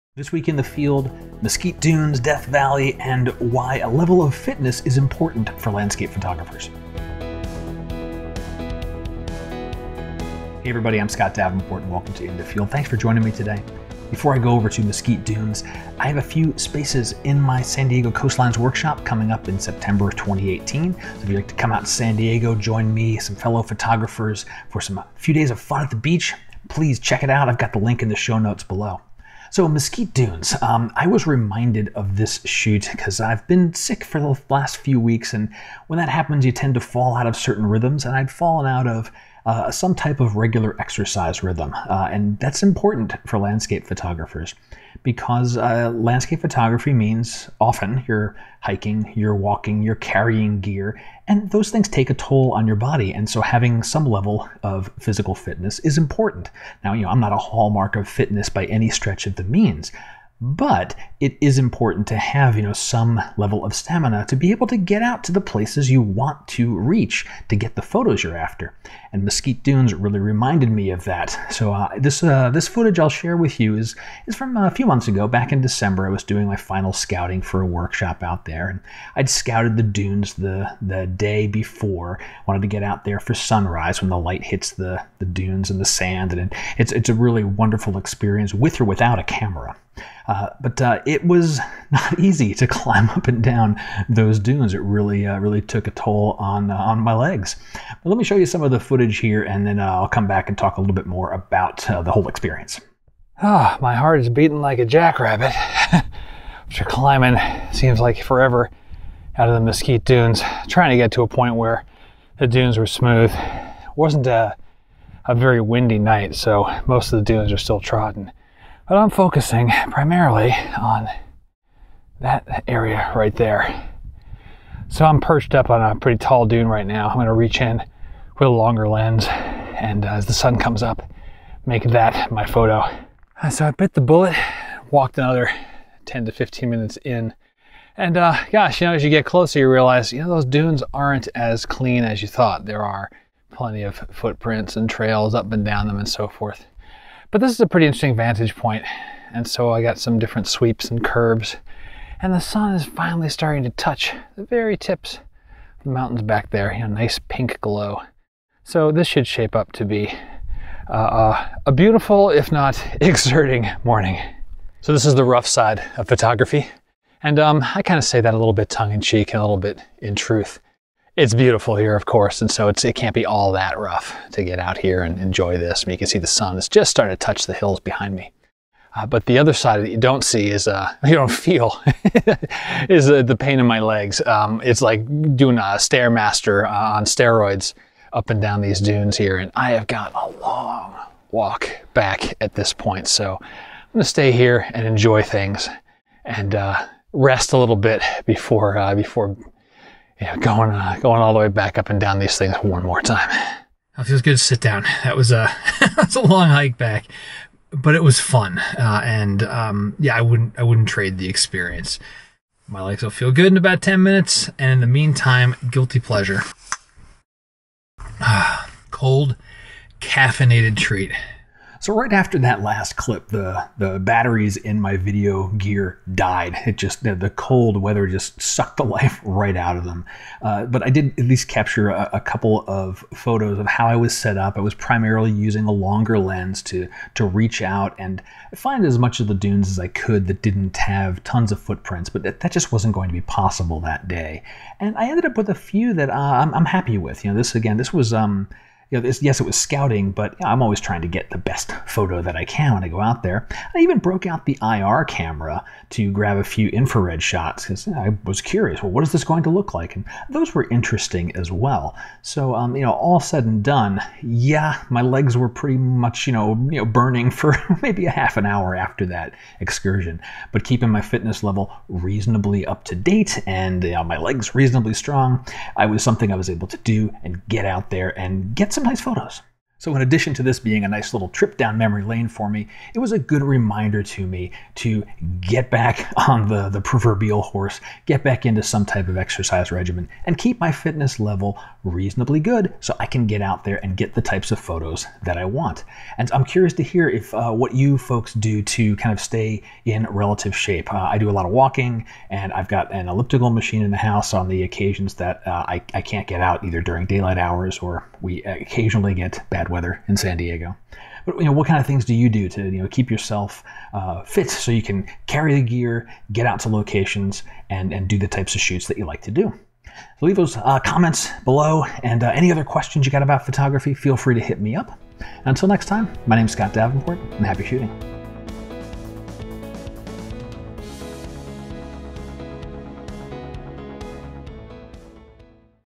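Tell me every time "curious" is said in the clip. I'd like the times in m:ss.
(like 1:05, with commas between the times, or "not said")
4:18, 4:56.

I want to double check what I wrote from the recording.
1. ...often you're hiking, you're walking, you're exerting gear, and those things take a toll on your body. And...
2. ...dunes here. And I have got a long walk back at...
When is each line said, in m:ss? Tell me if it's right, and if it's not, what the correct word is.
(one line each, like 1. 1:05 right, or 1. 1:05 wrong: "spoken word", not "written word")
1. 0:47 wrong: "carrying", not "exerting"
2. 3:08 right.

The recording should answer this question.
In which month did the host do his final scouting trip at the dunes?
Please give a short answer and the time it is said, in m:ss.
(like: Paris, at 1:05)
December, at 1:15.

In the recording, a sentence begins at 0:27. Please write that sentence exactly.
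I've got the link in the show notes below.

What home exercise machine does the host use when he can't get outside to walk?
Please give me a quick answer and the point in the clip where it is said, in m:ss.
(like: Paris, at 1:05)
elliptical machine, at 5:03.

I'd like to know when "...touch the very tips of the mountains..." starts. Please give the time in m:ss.
2:33.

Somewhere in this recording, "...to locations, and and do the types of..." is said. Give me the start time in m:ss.
5:16.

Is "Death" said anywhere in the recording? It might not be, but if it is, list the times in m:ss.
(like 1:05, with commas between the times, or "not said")
0:02.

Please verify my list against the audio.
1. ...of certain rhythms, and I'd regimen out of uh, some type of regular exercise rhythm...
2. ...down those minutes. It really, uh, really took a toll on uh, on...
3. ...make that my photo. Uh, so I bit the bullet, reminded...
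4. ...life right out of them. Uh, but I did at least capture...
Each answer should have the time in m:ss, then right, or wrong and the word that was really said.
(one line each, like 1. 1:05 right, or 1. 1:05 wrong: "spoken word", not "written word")
1. 0:37 wrong: "fallen", not "regimen"
2. 1:33 wrong: "dunes", not "minutes"
3. 2:11 wrong: "walked", not "reminded"
4. 3:48 right.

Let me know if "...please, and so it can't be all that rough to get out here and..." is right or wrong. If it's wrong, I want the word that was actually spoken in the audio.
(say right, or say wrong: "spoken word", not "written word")
wrong: "course", not "please".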